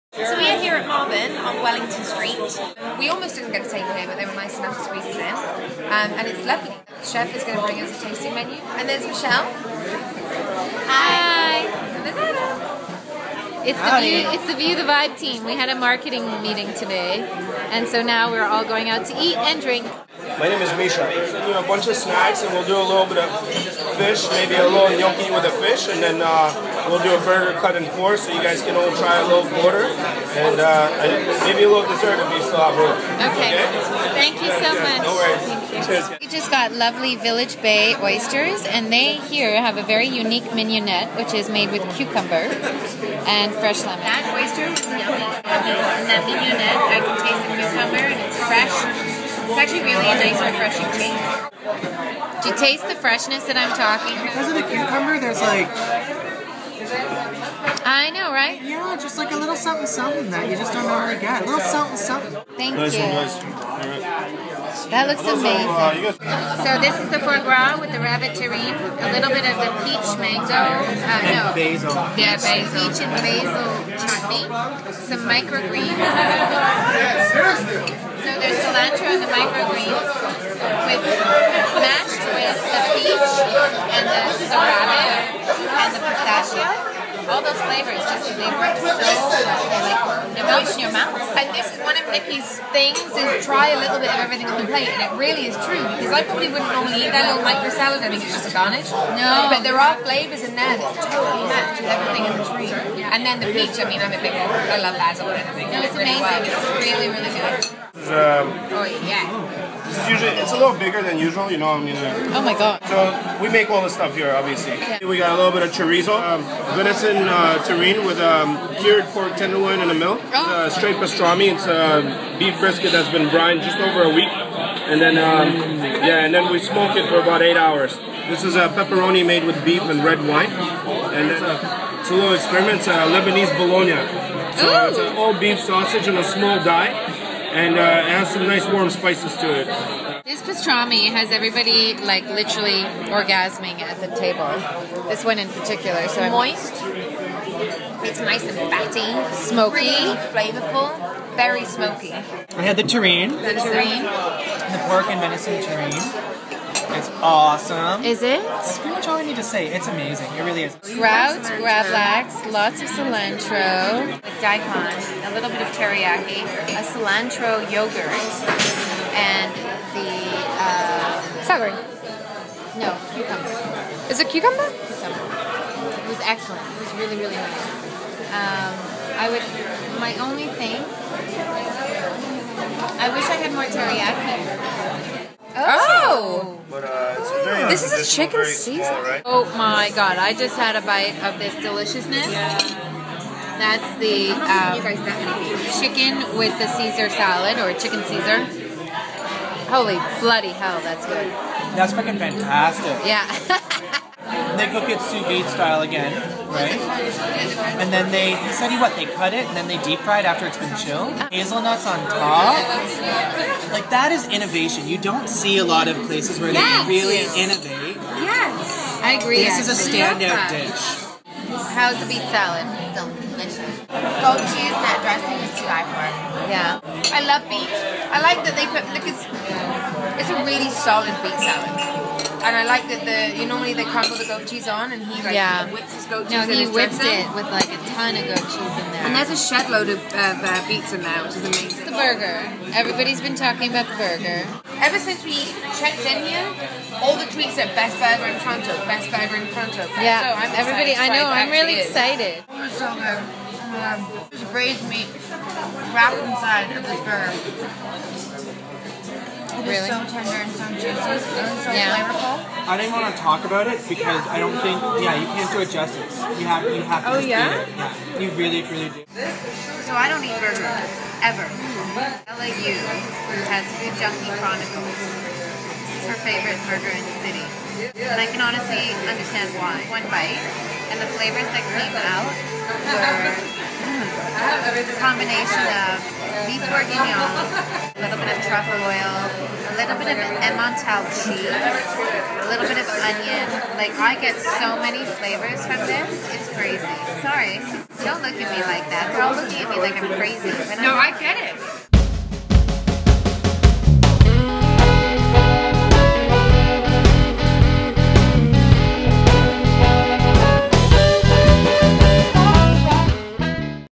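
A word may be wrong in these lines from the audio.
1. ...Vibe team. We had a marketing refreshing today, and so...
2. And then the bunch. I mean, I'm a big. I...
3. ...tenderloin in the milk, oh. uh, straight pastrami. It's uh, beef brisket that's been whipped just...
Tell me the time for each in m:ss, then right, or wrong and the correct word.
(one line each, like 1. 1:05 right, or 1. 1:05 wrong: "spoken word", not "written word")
1. 0:14 wrong: "meeting", not "refreshing"
2. 1:43 wrong: "peach", not "bunch"
3. 1:59 wrong: "brined", not "whipped".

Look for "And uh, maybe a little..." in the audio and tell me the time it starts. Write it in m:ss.
0:30.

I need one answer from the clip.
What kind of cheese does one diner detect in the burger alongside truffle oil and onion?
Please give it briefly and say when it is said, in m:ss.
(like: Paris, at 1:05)
emmental, at 4:50.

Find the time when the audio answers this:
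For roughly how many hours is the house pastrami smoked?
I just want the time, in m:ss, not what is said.
2:07.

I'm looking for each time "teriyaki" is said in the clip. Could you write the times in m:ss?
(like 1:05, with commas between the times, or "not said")
2:45, 3:03.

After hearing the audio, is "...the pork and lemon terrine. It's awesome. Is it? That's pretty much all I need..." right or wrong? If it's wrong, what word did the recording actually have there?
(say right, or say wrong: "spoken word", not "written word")
wrong: "venison", not "lemon".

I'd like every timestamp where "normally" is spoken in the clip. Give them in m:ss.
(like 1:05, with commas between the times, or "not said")
1:00, 1:36, 3:53.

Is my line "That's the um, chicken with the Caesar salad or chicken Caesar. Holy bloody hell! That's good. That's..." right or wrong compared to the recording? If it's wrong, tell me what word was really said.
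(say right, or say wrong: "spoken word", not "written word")
right.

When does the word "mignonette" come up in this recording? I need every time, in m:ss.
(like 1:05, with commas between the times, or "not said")
0:40, 0:46.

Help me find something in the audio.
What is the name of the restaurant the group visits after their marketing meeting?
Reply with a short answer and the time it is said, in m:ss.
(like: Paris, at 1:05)
Marben, at 0:00.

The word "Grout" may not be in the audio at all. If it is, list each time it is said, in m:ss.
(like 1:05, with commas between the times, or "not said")
2:40.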